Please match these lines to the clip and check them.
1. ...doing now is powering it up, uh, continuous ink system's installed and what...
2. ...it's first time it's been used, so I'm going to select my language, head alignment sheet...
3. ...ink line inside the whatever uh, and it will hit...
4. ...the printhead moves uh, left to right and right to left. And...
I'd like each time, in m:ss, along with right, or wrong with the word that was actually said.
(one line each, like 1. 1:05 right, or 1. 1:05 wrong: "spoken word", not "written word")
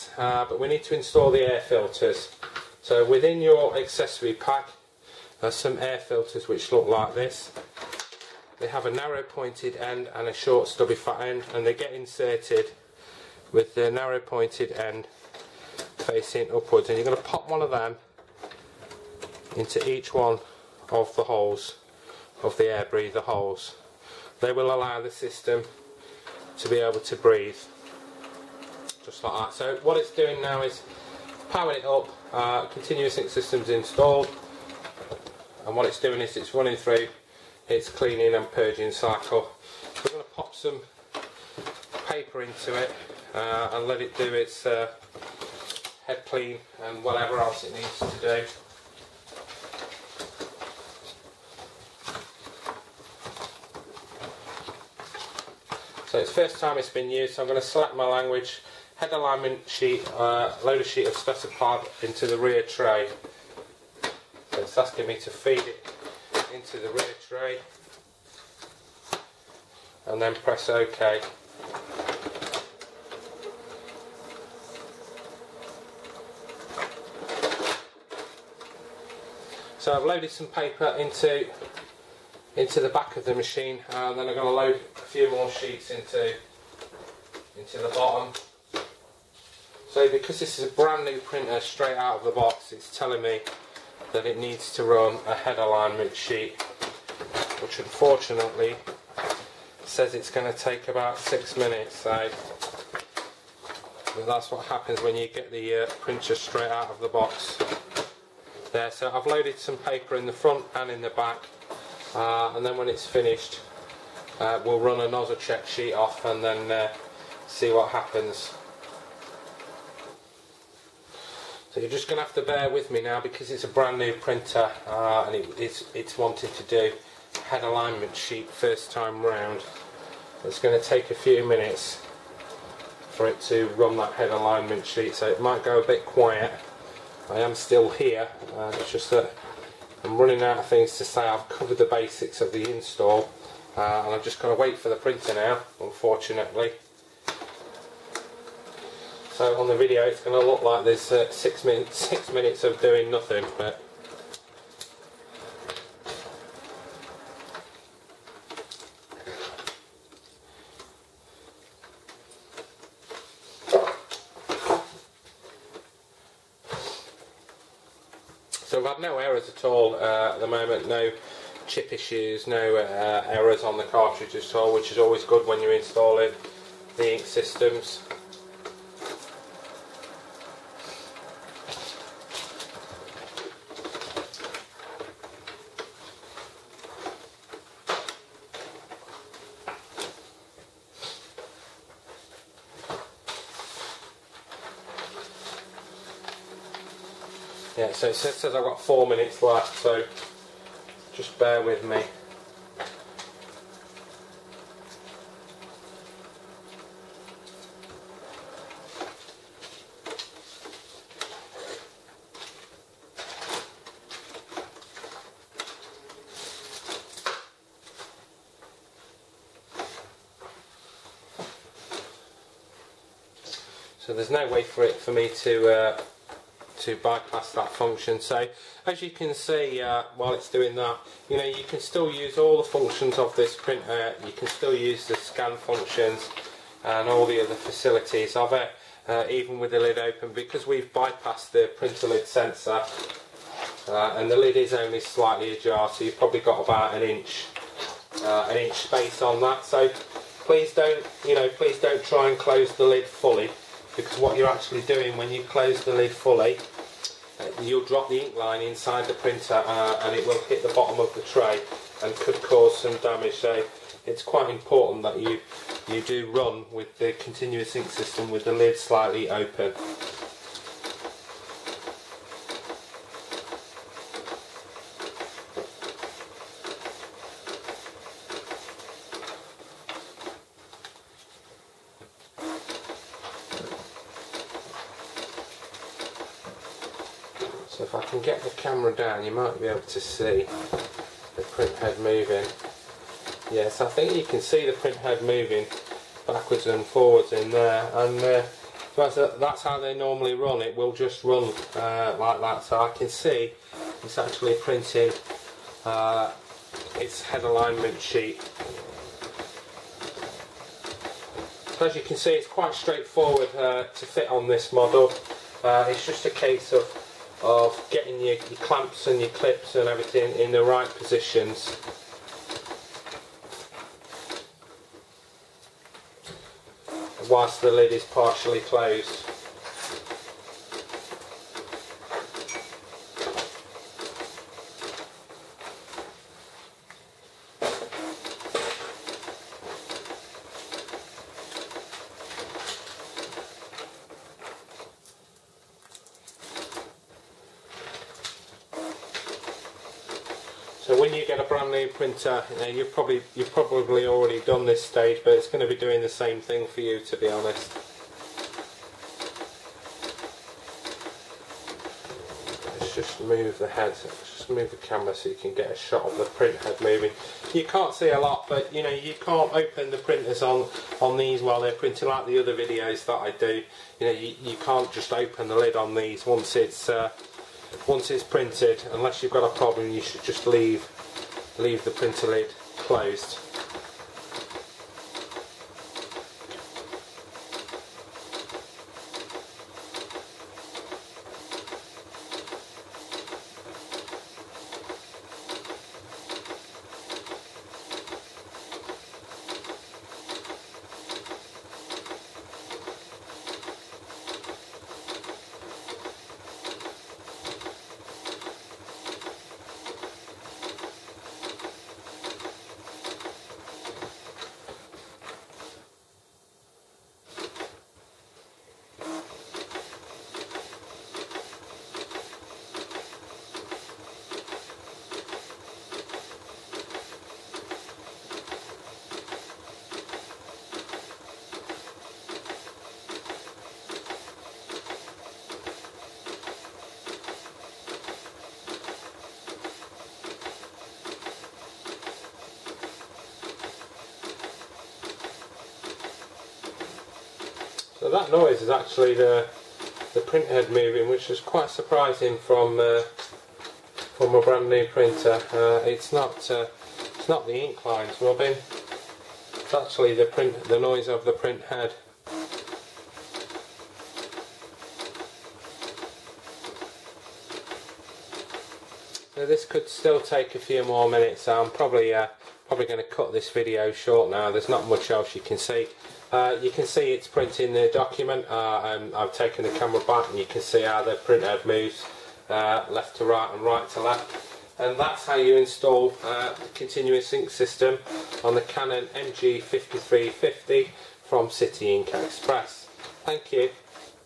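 1. 0:30 right
2. 0:56 right
3. 4:18 wrong: "printer", not "whatever"
4. 8:01 right.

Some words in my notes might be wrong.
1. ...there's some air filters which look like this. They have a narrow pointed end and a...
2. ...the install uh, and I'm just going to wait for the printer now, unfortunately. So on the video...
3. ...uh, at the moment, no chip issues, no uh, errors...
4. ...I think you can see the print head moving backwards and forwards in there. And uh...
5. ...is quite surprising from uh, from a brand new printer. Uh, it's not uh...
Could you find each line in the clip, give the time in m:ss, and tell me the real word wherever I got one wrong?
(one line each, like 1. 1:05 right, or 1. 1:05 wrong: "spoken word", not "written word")
1. 0:05 right
2. 2:22 right
3. 2:49 right
4. 4:53 right
5. 7:31 right.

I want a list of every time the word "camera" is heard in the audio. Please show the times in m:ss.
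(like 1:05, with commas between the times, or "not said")
4:48, 6:04, 7:59.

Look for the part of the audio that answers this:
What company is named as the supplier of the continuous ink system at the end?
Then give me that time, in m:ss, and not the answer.
8:11.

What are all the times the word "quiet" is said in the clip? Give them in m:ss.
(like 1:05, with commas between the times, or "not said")
2:16.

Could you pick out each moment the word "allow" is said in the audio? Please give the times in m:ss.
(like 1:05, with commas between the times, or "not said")
0:24.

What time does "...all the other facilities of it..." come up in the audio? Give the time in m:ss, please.
3:57.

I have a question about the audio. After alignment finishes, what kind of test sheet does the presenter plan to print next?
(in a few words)
nozzle check sheet.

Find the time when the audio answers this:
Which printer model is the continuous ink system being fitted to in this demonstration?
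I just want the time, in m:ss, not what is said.
8:08.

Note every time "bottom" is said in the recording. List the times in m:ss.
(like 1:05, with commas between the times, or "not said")
1:27, 4:20.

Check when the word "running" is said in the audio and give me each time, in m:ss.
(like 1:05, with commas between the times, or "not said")
0:36, 2:20.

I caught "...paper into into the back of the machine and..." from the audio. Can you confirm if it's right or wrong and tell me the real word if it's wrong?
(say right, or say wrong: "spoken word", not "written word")
right.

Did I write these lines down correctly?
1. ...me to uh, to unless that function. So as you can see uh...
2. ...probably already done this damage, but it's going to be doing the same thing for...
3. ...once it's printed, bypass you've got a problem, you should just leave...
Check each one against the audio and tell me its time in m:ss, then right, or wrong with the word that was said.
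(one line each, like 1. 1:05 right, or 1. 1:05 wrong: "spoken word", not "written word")
1. 3:45 wrong: "bypass", not "unless"
2. 5:53 wrong: "stage", not "damage"
3. 6:17 wrong: "unless", not "bypass".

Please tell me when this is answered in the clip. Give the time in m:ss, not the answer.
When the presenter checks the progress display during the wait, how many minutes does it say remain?
3:18.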